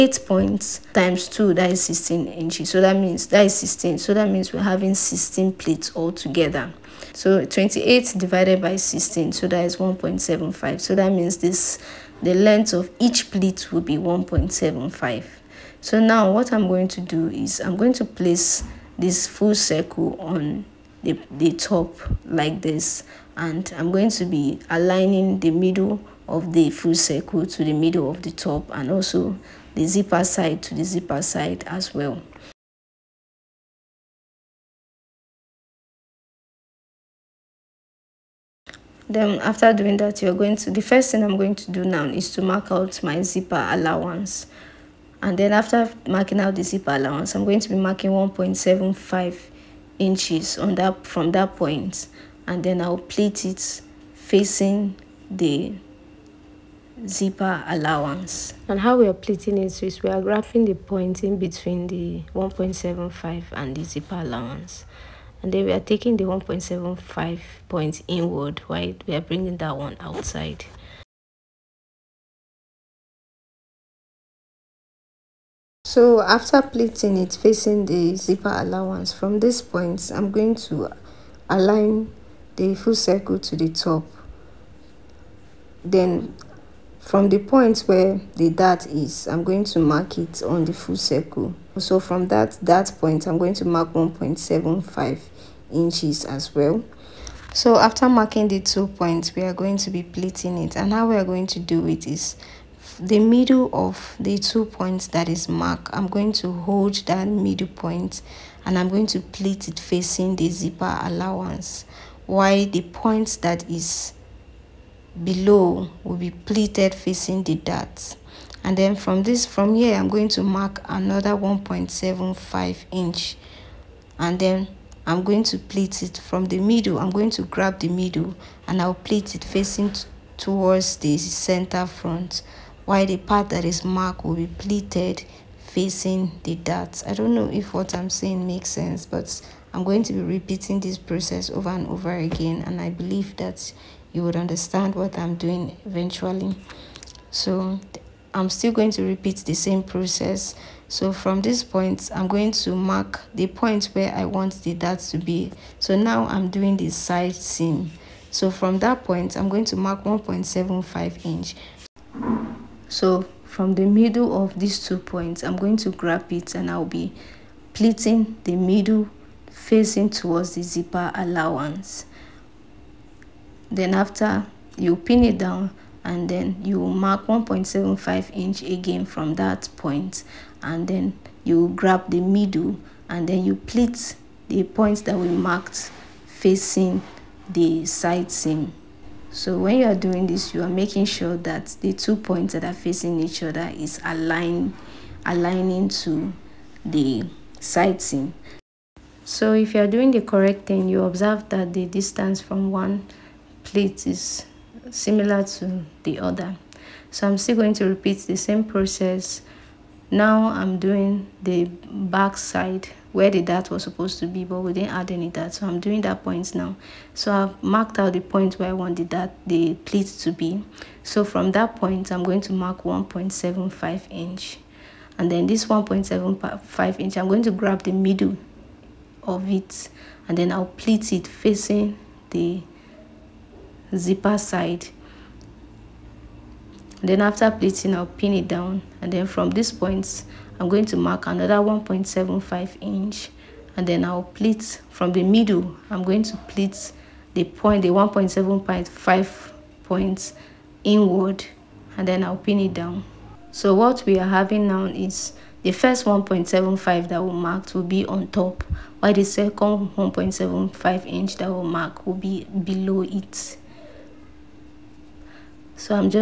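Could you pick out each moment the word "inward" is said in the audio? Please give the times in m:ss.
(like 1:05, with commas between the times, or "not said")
1:08, 4:10.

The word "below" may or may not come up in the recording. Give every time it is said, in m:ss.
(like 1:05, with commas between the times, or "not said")
1:55, 4:22.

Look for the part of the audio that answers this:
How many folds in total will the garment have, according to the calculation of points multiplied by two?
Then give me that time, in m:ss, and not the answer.
0:04.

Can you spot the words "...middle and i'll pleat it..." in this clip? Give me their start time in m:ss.
2:07.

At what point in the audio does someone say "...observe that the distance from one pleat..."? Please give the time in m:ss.
3:21.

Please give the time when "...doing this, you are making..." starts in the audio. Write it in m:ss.
3:09.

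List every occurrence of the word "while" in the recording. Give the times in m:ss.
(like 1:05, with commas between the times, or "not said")
1:08, 1:52, 2:12, 4:18.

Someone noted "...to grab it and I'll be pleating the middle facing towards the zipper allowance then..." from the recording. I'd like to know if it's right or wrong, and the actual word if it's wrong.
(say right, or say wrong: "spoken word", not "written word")
right.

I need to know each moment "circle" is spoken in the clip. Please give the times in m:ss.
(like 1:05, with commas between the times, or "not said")
0:19, 0:26, 1:22, 1:30.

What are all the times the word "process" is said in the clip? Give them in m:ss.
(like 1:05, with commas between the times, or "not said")
2:20, 2:29, 3:28.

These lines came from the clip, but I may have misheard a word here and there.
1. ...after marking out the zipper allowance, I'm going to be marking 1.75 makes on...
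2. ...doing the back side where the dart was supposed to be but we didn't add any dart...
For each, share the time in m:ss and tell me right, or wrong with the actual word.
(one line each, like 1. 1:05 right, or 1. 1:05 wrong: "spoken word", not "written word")
1. 0:45 wrong: "inches", not "makes"
2. 3:30 right.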